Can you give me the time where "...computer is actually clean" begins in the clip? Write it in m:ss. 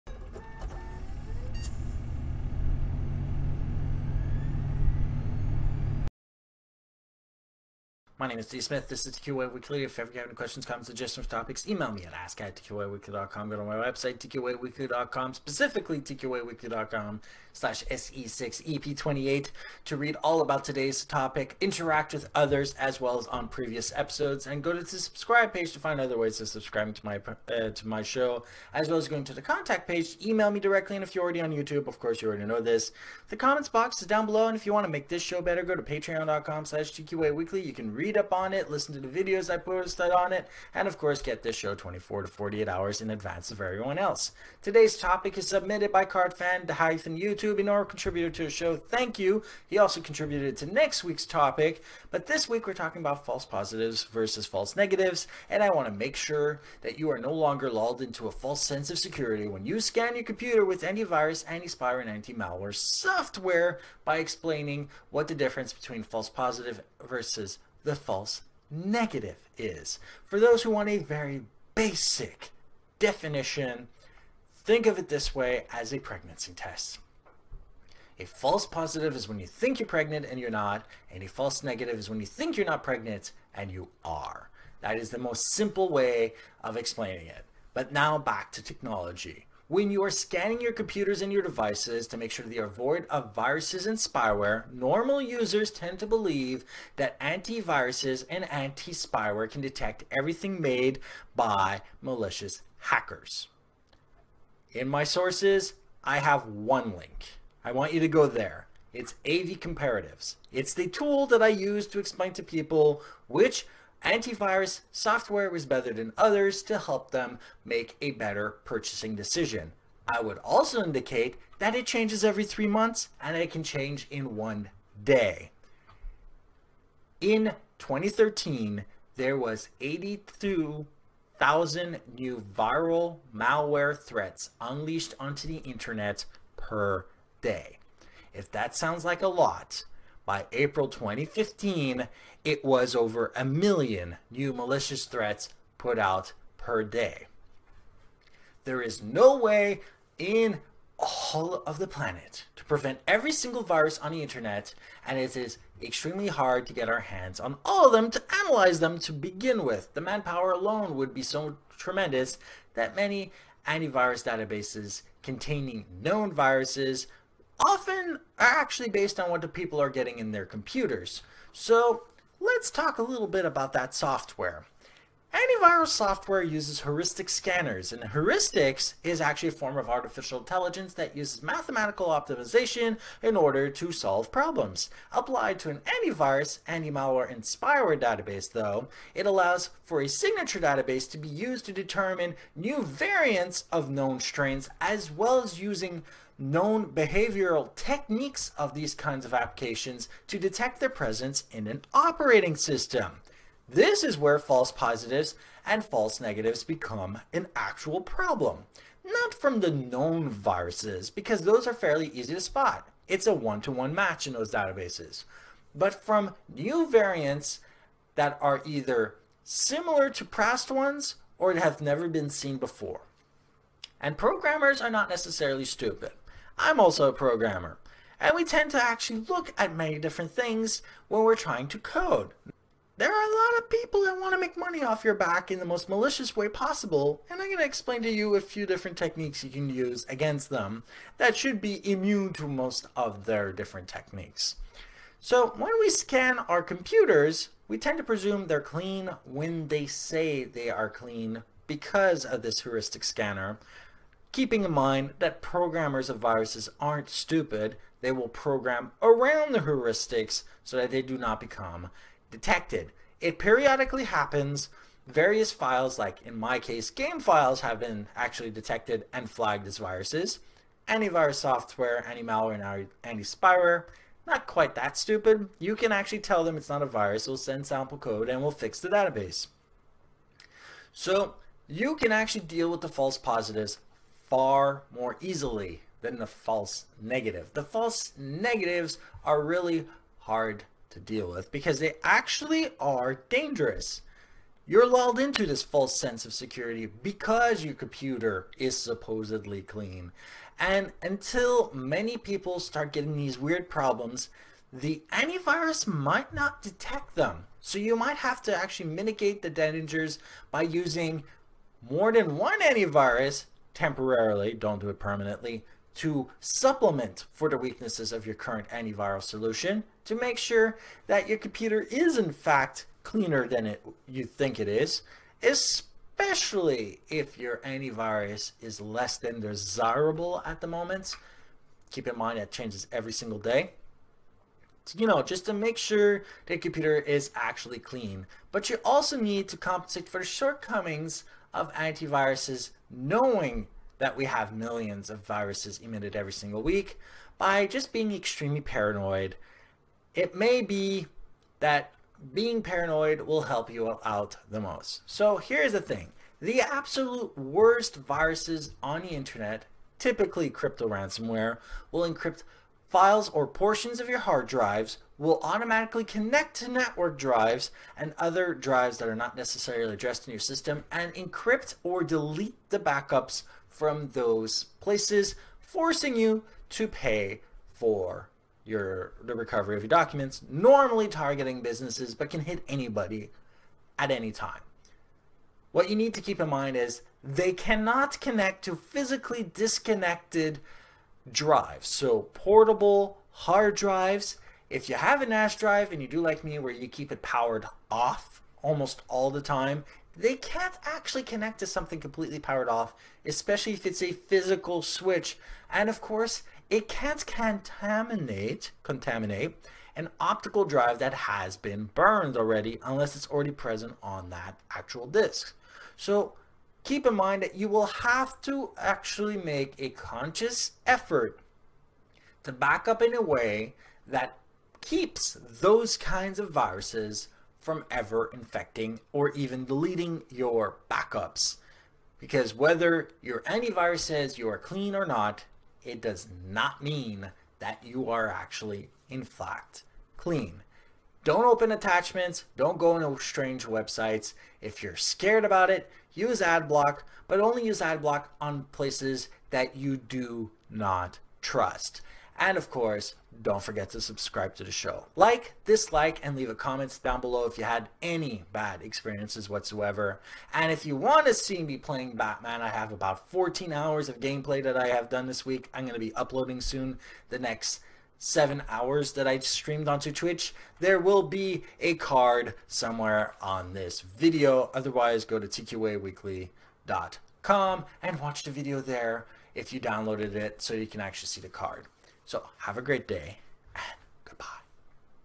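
5:36.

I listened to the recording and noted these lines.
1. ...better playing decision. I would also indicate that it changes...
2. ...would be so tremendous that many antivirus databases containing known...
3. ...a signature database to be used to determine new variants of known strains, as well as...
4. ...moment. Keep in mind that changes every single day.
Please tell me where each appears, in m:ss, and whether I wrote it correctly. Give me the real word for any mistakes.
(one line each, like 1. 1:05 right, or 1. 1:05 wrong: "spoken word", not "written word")
1. 1:58 wrong: "purchasing", not "playing"
2. 2:40 right
3. 3:10 right
4. 5:30 right.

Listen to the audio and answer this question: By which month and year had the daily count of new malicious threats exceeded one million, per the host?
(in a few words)
April 2015.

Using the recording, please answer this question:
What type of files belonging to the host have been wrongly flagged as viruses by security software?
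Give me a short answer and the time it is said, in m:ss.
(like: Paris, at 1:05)
Game files, at 4:26.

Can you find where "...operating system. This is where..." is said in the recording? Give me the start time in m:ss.
3:21.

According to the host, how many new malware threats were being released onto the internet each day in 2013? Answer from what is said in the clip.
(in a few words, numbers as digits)
82,000.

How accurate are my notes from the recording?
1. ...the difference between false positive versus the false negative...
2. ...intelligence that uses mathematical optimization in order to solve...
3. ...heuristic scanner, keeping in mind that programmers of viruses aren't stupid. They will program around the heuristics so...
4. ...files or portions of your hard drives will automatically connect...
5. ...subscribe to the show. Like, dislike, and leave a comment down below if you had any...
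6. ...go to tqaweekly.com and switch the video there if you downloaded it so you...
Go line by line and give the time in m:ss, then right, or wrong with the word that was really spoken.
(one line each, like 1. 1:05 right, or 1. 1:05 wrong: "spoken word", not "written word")
1. 1:05 right
2. 3:00 right
3. 4:12 right
4. 6:02 right
5. 7:34 right
6. 7:55 wrong: "watch", not "switch".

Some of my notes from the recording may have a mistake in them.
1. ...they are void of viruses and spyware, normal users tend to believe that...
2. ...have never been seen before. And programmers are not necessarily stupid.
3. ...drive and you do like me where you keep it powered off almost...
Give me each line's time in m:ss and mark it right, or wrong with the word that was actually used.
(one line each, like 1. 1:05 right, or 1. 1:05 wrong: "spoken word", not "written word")
1. 1:32 right
2. 3:41 right
3. 6:35 right.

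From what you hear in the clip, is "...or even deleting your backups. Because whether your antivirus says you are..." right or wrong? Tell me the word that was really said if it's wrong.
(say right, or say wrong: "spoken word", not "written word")
right.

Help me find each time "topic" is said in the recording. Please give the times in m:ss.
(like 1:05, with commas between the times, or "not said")
0:11, 0:21, 0:44, 0:51.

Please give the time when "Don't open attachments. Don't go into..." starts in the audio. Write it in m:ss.
7:21.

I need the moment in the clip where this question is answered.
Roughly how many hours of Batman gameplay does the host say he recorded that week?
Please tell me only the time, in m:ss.
7:43.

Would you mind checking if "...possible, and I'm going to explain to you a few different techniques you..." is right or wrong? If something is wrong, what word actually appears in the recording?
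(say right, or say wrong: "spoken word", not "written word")
right.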